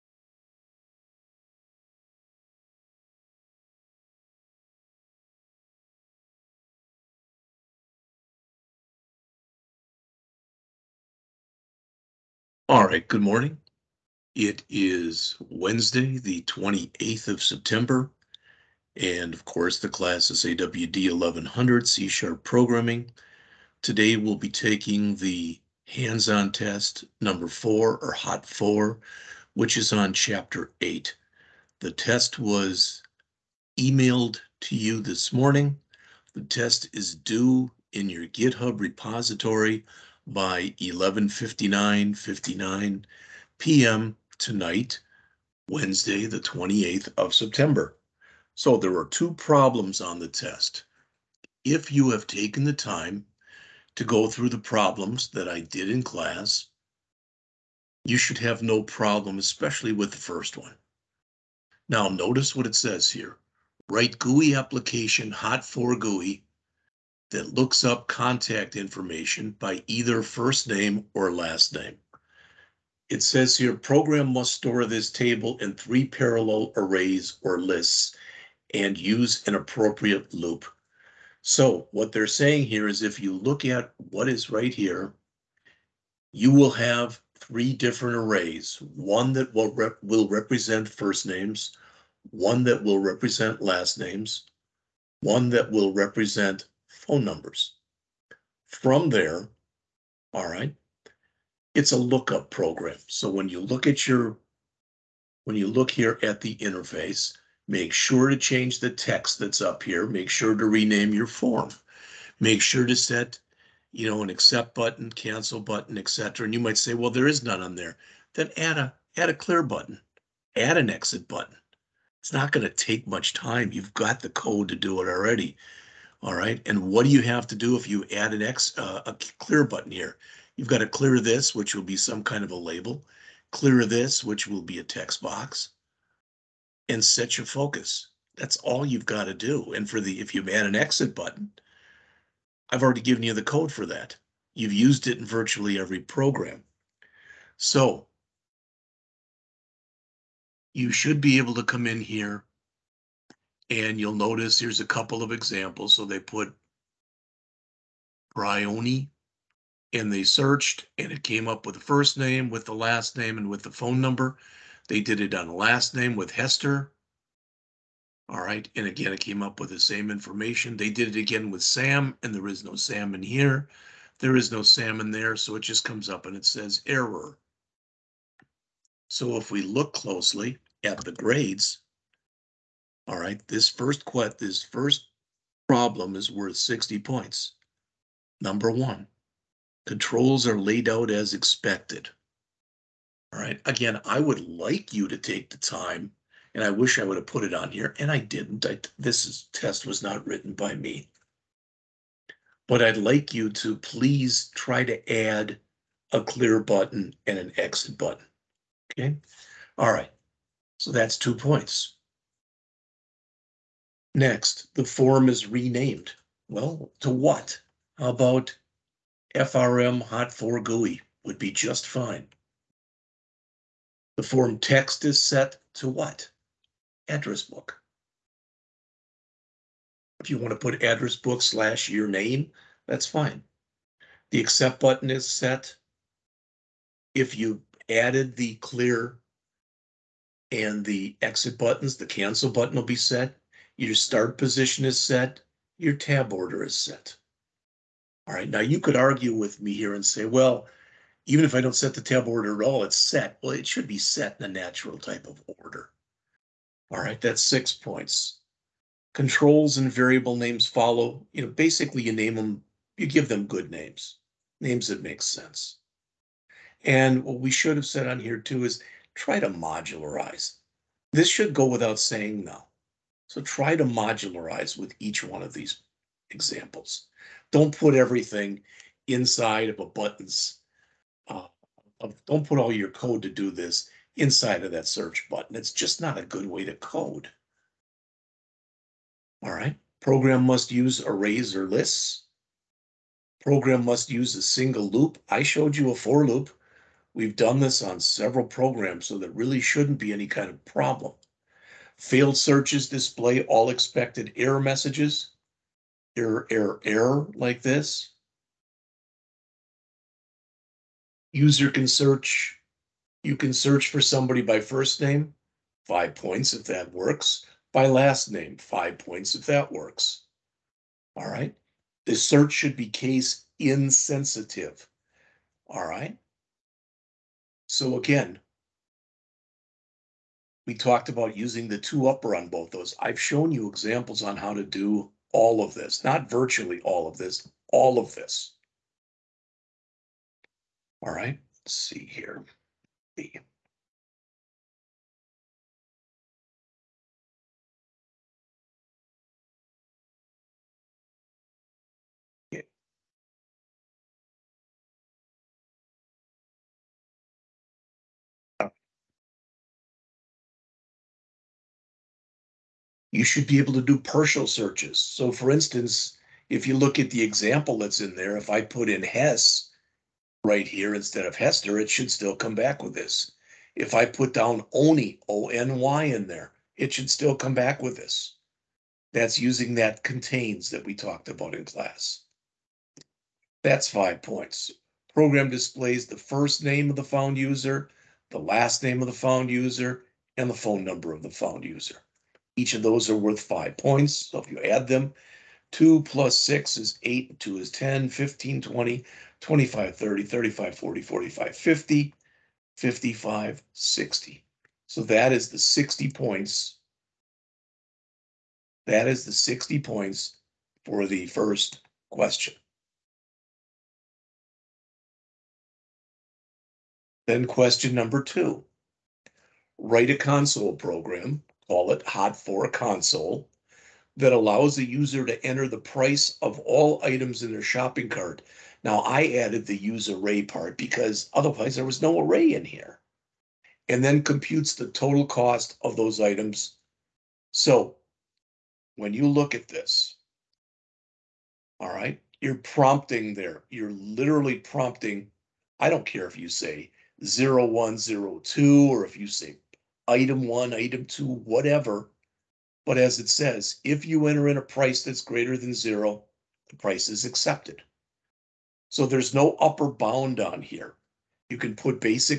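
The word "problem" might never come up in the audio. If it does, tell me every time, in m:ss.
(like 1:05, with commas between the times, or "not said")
0:49, 0:54, 0:58, 3:05, 5:00.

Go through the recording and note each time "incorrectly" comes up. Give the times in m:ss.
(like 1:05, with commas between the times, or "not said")
not said.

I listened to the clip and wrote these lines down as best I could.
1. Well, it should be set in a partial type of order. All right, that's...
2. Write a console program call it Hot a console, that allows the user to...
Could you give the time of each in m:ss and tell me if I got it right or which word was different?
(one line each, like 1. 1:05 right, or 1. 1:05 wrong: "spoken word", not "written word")
1. 4:13 wrong: "natural", not "partial"
2. 6:59 right.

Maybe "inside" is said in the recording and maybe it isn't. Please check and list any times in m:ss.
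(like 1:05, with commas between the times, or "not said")
4:39, 4:44.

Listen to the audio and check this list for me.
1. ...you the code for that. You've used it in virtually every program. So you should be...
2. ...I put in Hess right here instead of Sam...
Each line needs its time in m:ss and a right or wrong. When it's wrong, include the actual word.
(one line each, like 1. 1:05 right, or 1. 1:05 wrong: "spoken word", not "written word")
1. 2:23 right
2. 6:08 wrong: "Hester", not "Sam".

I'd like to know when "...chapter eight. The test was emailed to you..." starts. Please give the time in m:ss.
0:30.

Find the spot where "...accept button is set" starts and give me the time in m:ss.
3:54.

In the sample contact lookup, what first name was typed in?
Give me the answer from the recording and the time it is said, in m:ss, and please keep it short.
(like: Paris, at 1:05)
Bryony, at 2:38.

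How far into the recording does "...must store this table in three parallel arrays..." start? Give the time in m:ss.
1:14.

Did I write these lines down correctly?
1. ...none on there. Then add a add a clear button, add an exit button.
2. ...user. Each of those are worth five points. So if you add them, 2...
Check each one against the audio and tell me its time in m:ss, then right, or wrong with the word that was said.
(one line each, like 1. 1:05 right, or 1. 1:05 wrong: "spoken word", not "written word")
1. 1:57 right
2. 6:31 right.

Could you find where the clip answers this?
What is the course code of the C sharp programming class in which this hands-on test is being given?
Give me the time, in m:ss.
0:20.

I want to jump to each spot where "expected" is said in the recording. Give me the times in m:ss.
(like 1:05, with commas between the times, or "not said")
3:11, 5:03.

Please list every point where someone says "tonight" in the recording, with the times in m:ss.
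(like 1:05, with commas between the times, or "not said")
0:44.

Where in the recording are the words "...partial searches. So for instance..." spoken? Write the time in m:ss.
6:03.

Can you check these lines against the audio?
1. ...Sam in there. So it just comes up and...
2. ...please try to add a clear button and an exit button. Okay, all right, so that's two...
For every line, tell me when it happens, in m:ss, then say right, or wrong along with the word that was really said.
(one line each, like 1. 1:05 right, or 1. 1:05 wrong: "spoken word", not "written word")
1. 2:54 right
2. 3:23 right.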